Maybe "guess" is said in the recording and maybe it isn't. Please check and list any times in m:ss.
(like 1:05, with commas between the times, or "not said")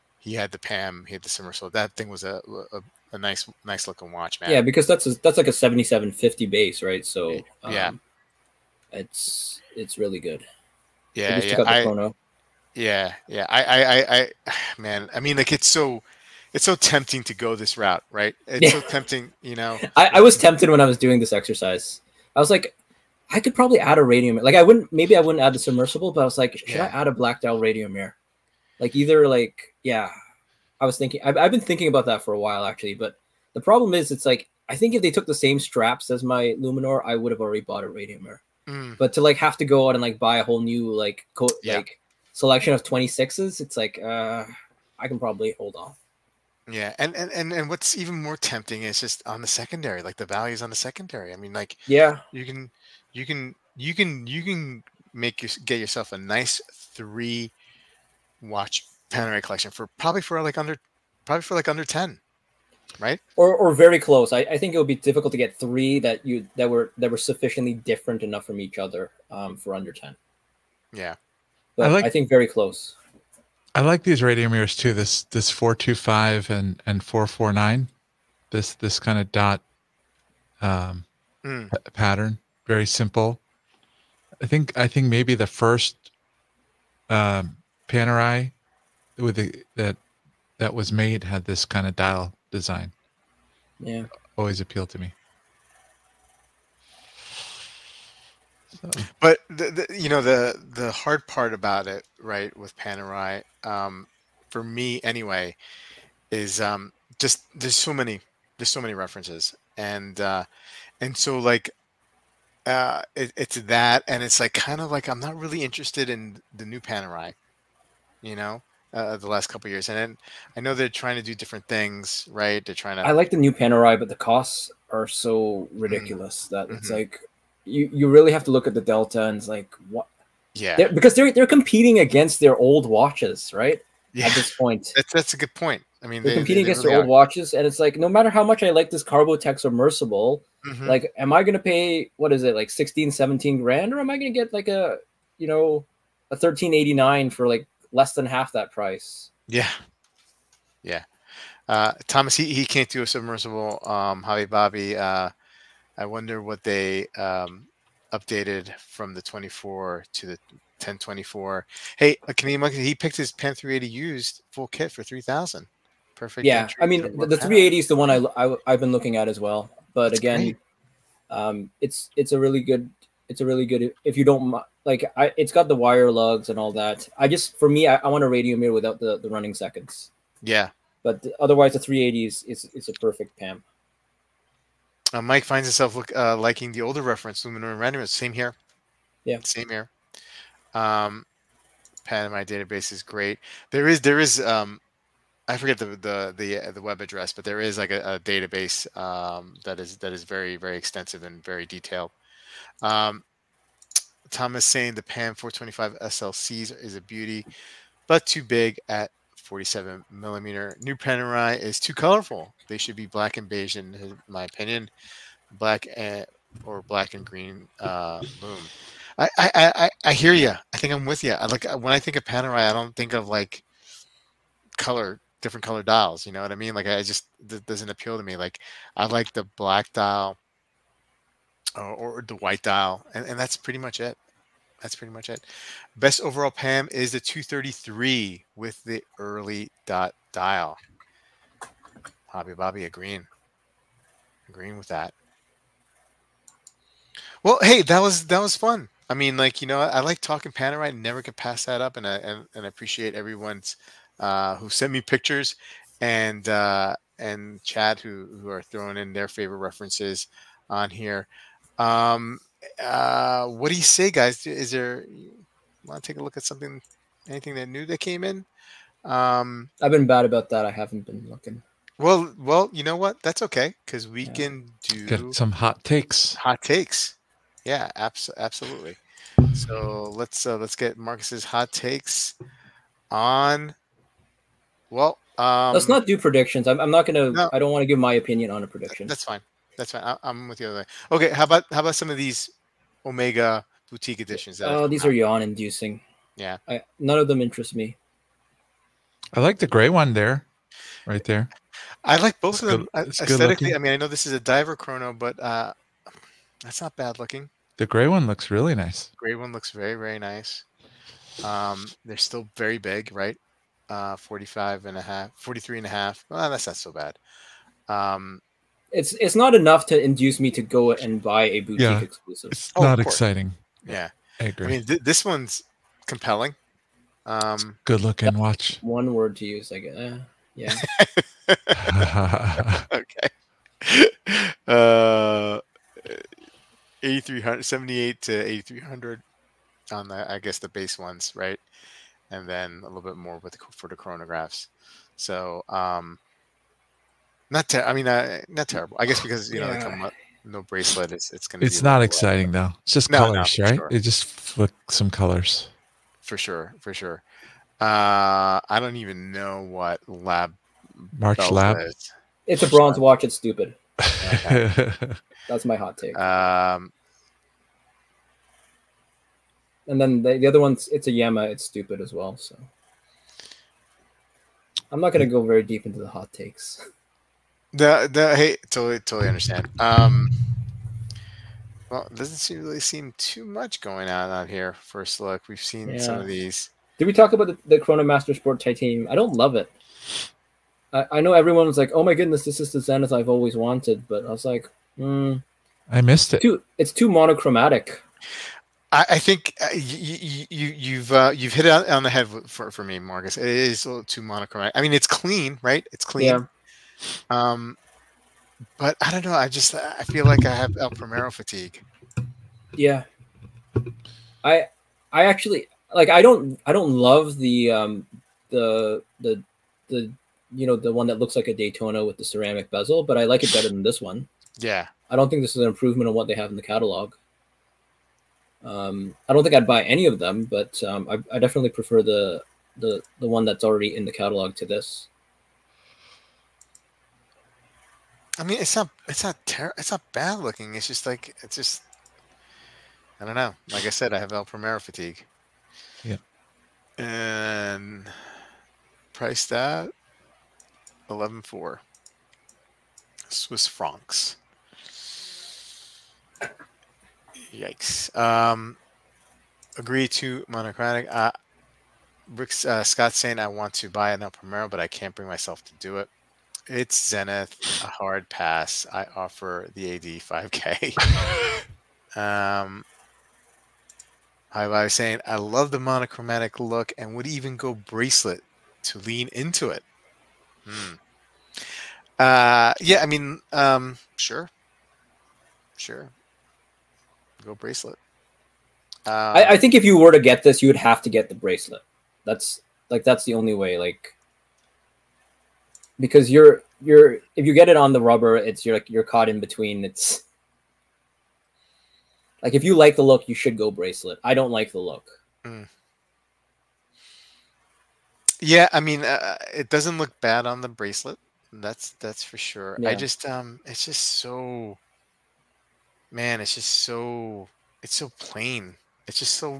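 5:29, 5:40, 5:49.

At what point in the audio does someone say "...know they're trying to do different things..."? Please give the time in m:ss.
2:00.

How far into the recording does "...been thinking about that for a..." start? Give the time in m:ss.
0:31.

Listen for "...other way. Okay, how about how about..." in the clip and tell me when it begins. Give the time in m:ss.
4:50.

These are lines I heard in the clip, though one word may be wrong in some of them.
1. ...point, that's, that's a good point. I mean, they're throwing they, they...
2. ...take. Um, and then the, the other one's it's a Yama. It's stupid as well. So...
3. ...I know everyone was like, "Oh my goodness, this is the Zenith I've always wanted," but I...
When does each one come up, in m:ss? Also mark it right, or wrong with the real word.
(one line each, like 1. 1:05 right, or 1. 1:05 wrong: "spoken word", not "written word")
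1. 2:14 wrong: "competing", not "throwing"
2. 6:05 right
3. 6:31 right.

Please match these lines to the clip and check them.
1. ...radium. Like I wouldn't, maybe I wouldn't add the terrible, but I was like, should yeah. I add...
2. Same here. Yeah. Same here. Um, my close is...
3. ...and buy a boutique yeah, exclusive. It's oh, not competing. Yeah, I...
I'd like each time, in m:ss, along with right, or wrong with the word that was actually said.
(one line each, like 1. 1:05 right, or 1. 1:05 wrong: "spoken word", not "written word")
1. 0:24 wrong: "submersible", not "terrible"
2. 3:08 wrong: "database", not "close"
3. 5:20 wrong: "exciting", not "competing".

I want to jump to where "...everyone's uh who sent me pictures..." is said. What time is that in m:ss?
4:13.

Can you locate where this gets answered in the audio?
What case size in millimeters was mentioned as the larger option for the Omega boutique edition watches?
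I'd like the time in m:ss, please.
5:14.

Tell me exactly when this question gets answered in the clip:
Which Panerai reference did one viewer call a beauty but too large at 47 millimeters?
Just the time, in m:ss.
3:25.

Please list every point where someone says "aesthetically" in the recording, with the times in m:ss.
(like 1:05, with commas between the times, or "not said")
5:03.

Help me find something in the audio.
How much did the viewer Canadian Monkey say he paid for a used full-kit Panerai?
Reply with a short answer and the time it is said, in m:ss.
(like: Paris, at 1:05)
3000, at 2:45.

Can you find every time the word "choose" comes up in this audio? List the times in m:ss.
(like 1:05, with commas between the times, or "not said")
not said.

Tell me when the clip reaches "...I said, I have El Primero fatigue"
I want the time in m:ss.
7:23.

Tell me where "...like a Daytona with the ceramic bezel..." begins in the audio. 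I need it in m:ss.
7:01.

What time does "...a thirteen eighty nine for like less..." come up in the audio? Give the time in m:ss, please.
2:26.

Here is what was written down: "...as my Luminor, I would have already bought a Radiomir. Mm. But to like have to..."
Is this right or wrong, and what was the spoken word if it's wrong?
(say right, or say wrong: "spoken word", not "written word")
right.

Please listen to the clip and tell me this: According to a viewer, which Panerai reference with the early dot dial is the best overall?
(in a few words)
233.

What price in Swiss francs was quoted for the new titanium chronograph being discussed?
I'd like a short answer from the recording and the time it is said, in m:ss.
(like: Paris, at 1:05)
11,400, at 7:31.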